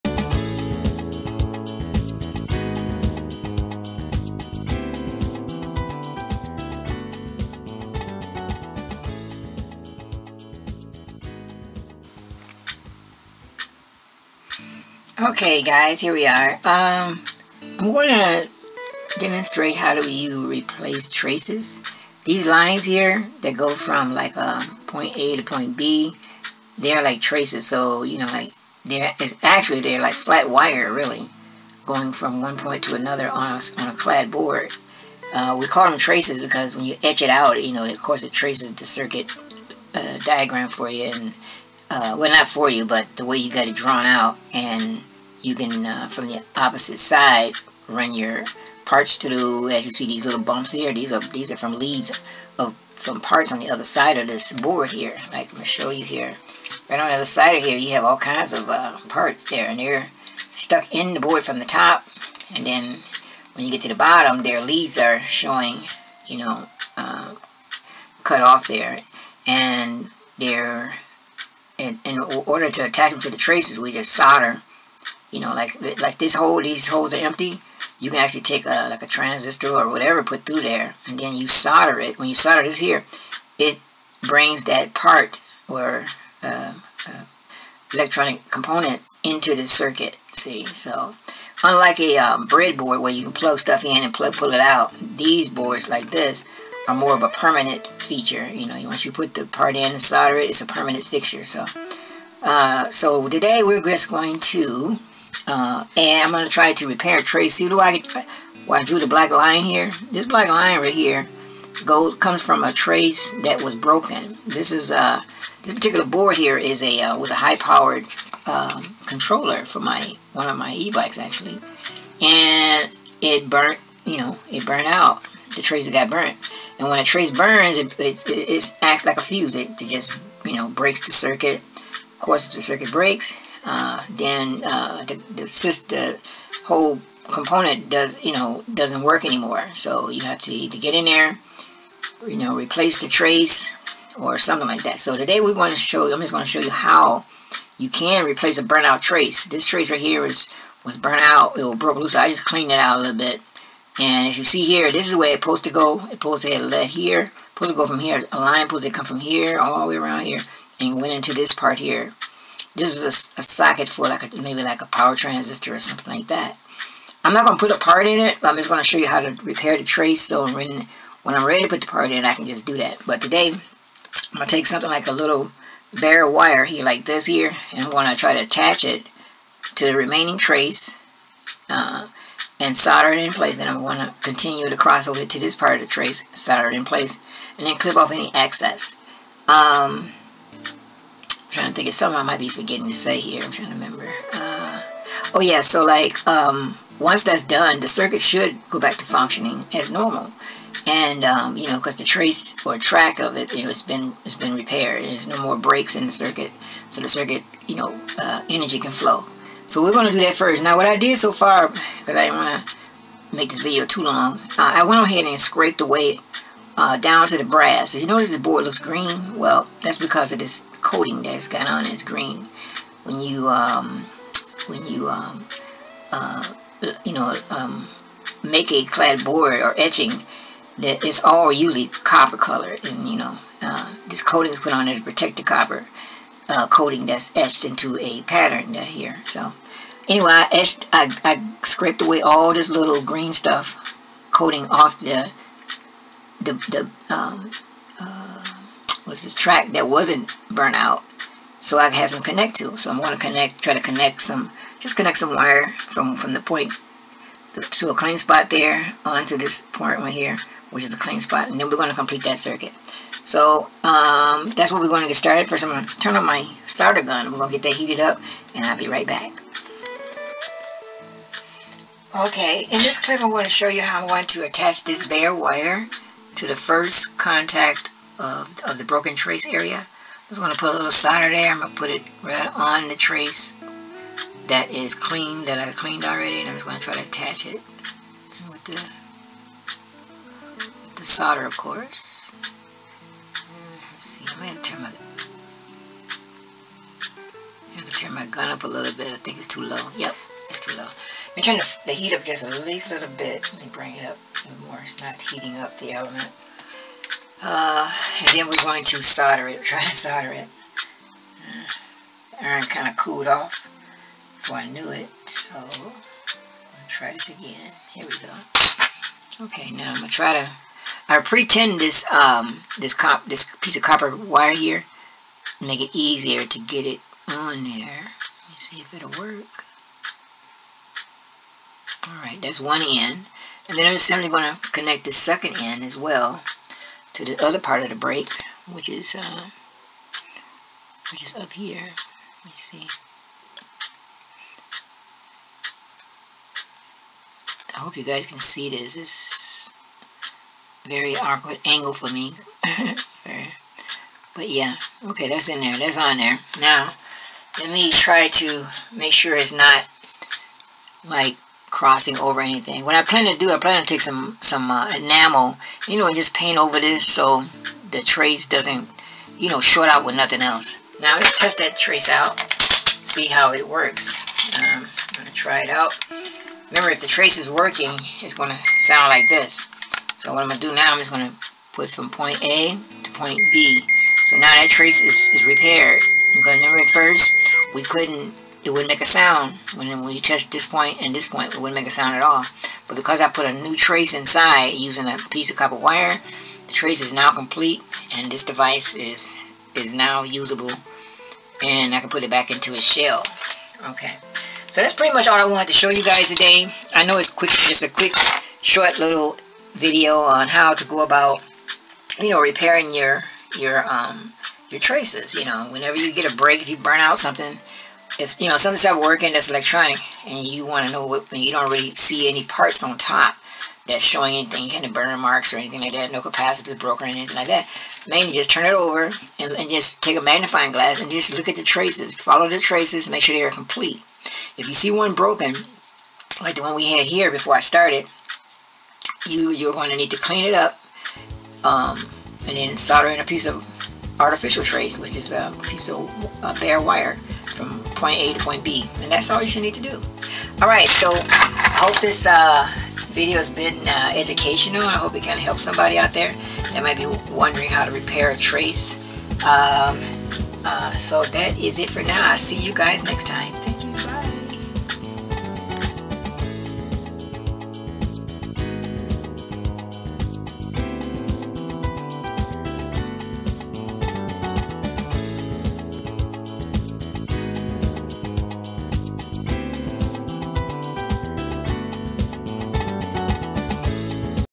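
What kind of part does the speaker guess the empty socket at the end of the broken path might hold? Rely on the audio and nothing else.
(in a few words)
Power transistor.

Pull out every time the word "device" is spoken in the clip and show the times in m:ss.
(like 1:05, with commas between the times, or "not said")
6:38.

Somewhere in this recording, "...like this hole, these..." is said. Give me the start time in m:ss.
1:16.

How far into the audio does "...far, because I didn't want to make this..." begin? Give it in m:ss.
3:31.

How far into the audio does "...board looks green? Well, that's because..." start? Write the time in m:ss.
3:38.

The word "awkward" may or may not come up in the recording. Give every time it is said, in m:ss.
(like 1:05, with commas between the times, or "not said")
5:51.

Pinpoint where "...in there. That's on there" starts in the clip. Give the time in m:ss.
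5:55.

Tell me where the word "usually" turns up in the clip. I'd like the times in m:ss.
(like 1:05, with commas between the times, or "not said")
3:51.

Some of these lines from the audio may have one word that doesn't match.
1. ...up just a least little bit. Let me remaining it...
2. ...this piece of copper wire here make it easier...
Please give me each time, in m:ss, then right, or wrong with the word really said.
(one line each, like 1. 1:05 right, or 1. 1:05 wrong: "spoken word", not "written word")
1. 5:02 wrong: "bring", not "remaining"
2. 5:23 right.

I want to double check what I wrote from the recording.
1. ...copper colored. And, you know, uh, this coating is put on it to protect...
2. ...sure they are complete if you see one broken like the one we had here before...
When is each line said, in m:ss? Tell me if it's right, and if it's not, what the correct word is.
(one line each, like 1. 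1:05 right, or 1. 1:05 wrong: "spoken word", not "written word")
1. 3:52 right
2. 7:13 right.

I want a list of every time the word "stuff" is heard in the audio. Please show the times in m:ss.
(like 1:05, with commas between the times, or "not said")
1:33, 4:03.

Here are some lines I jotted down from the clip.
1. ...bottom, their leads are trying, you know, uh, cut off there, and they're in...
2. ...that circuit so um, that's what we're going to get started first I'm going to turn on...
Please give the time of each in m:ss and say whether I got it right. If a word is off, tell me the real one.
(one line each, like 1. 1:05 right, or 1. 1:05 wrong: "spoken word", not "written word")
1. 1:03 wrong: "showing", not "trying"
2. 4:22 right.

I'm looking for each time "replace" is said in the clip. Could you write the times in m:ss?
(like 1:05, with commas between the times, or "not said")
0:20, 2:22, 2:28.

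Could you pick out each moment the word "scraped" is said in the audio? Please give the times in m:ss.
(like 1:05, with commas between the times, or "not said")
3:35, 4:01.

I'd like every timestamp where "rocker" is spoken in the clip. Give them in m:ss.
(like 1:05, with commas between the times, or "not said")
not said.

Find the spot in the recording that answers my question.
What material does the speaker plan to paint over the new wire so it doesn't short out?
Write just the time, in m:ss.
6:04.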